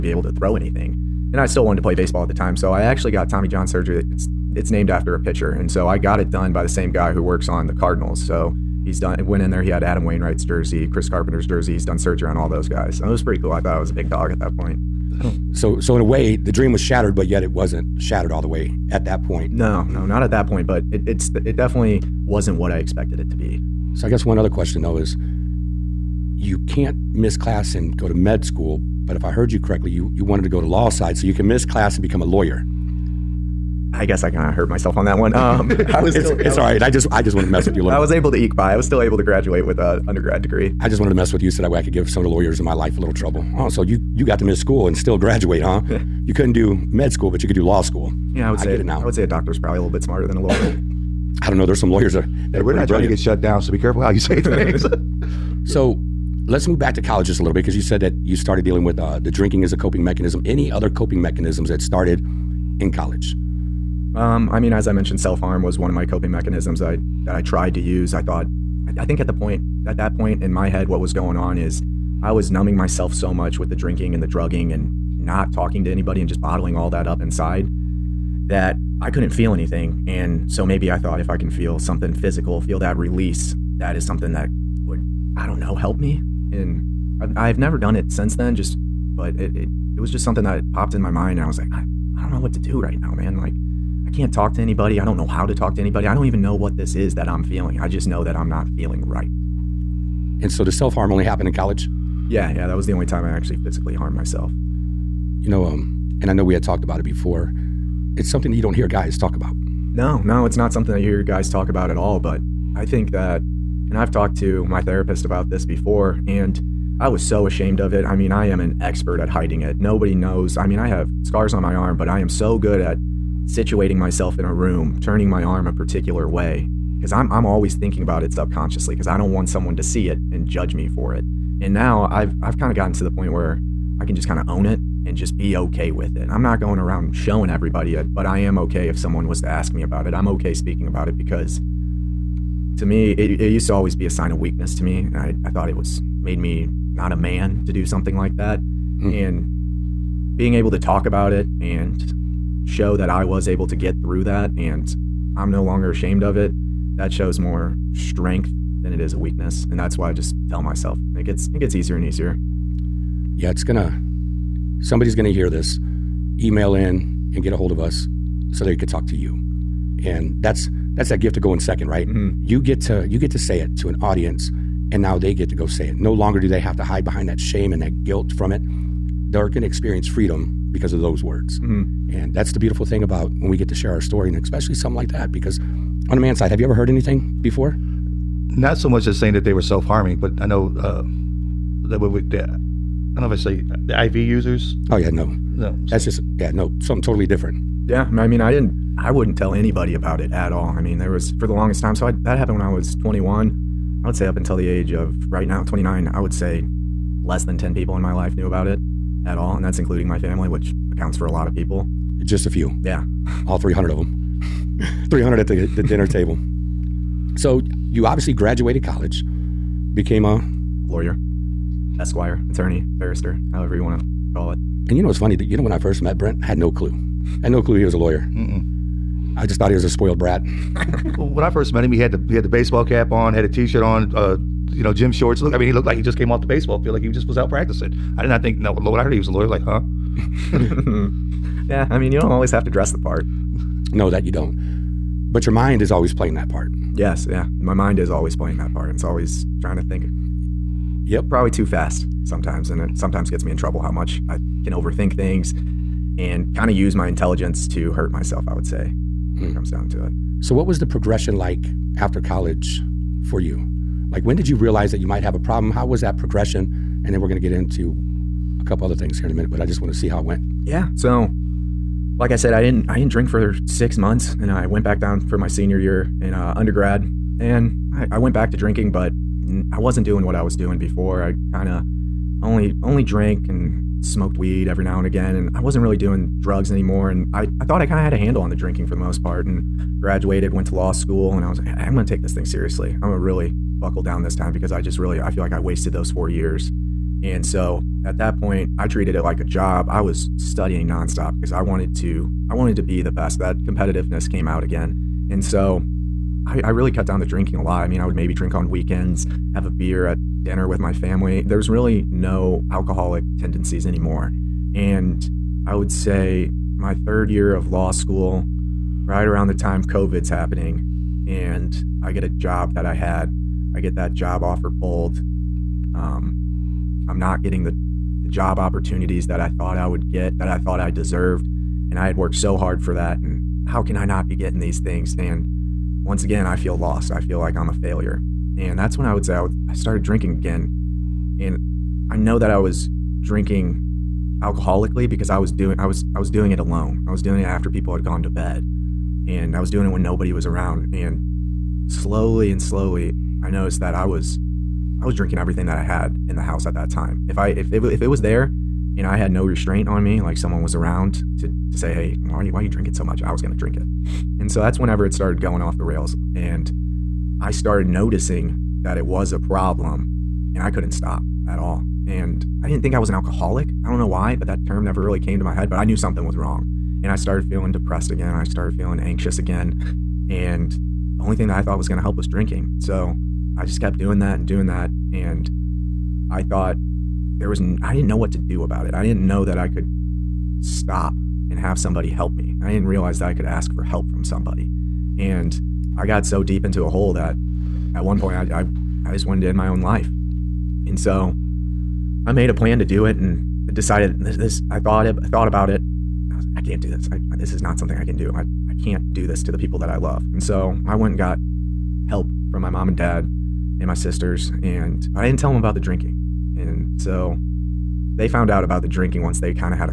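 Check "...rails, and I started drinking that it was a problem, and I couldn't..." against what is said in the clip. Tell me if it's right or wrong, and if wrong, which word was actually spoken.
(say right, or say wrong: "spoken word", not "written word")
wrong: "noticing", not "drinking".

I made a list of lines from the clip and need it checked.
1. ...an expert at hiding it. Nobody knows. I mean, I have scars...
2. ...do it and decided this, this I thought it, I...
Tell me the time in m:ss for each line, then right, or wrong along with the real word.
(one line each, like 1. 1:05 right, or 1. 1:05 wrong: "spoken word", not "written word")
1. 1:58 right
2. 6:42 right.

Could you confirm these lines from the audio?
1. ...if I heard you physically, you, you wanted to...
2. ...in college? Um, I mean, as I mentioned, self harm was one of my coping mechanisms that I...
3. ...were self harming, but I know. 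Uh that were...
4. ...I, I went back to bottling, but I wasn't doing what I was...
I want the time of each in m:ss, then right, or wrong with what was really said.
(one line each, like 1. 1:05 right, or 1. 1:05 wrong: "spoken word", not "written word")
1. 0:29 wrong: "correctly", not "physically"
2. 1:02 right
3. 3:09 right
4. 4:37 wrong: "drinking", not "bottling".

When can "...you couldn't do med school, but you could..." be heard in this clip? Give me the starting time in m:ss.
0:46.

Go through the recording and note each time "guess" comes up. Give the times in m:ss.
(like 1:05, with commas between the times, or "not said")
0:24, 0:34.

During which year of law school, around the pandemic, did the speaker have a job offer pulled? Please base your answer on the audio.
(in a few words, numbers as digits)
Third year.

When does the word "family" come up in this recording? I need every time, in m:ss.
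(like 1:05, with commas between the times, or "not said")
3:30, 5:10.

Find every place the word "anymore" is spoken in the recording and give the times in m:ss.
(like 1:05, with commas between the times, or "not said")
4:46, 5:13.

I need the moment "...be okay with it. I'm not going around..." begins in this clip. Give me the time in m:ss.
2:15.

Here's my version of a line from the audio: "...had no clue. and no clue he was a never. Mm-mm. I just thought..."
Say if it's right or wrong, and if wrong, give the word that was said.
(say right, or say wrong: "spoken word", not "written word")
wrong: "lawyer", not "never".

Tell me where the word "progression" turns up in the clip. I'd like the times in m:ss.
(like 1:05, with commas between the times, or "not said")
4:20, 4:26.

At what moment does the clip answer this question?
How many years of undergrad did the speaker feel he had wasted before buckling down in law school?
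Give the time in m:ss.
4:56.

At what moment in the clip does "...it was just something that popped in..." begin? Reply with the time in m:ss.
1:29.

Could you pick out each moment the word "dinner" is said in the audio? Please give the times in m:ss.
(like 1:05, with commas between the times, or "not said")
3:35, 5:10.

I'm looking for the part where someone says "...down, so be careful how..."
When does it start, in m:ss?
0:53.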